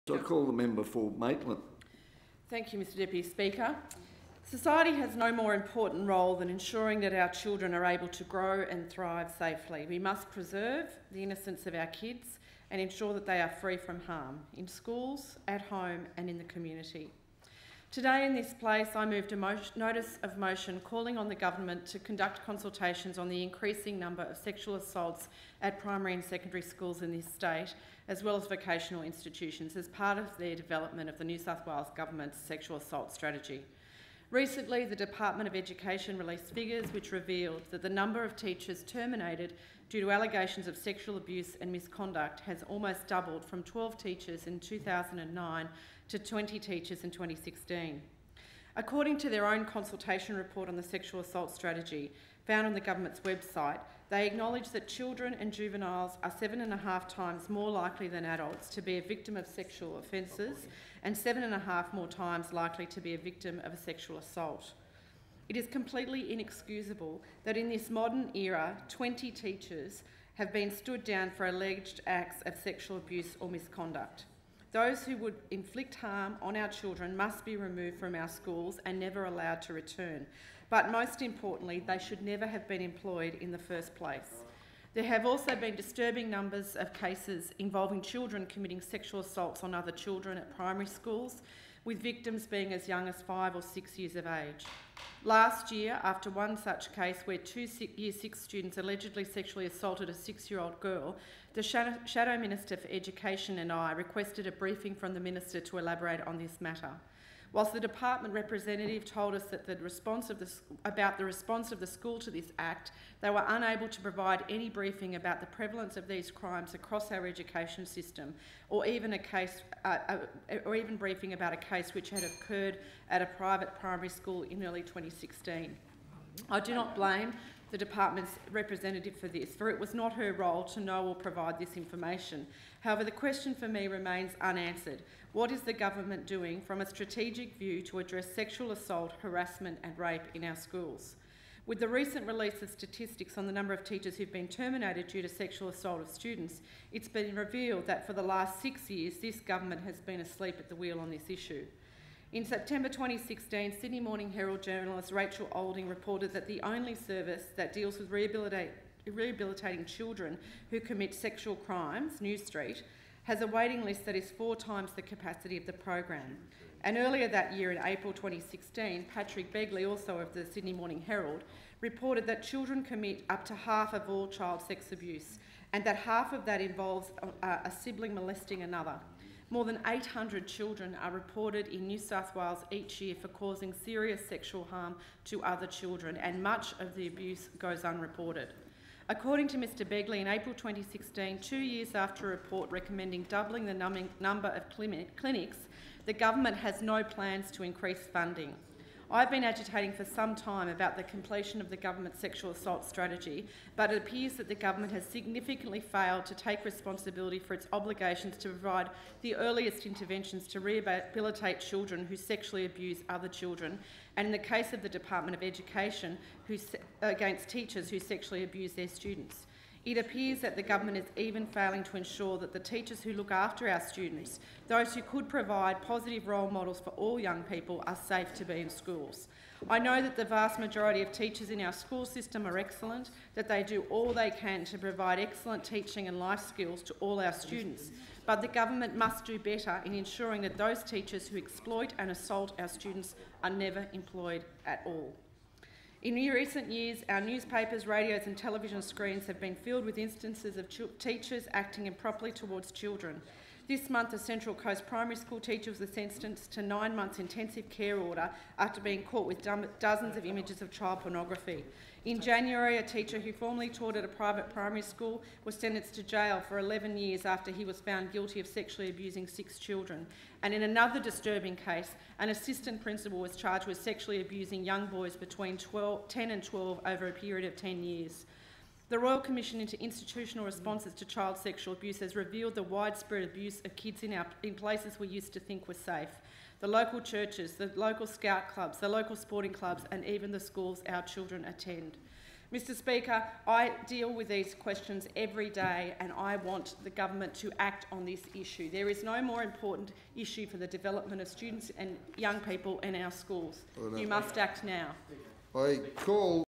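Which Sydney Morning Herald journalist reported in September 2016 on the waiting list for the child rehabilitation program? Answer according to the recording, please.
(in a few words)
Rachel Olding.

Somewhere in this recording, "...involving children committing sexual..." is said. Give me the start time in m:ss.
1:27.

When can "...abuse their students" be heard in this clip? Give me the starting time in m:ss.
3:38.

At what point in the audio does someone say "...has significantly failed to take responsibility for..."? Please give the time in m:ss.
3:24.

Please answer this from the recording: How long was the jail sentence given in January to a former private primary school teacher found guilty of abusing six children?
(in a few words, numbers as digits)
11 years.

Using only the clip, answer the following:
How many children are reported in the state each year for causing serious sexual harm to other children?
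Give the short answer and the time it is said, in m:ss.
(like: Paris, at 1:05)
More than 800, at 2:59.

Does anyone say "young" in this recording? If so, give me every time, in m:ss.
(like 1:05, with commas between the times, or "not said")
1:32, 3:47, 4:34, 5:02.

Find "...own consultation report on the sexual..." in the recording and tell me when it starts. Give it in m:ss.
0:49.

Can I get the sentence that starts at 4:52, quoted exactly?
Mr Speaker, I deal with these questions every day and I want the government to act on this issue.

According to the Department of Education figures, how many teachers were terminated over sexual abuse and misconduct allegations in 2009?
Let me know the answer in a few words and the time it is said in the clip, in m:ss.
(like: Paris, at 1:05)
12, at 0:43.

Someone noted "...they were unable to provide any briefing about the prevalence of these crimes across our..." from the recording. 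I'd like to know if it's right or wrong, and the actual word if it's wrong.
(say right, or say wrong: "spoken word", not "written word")
right.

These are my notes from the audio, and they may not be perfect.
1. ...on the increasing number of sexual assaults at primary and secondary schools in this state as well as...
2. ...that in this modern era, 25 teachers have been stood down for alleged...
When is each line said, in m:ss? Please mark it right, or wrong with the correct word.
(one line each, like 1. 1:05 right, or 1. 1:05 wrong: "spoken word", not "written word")
1. 0:23 right
2. 1:07 wrong: "20", not "25".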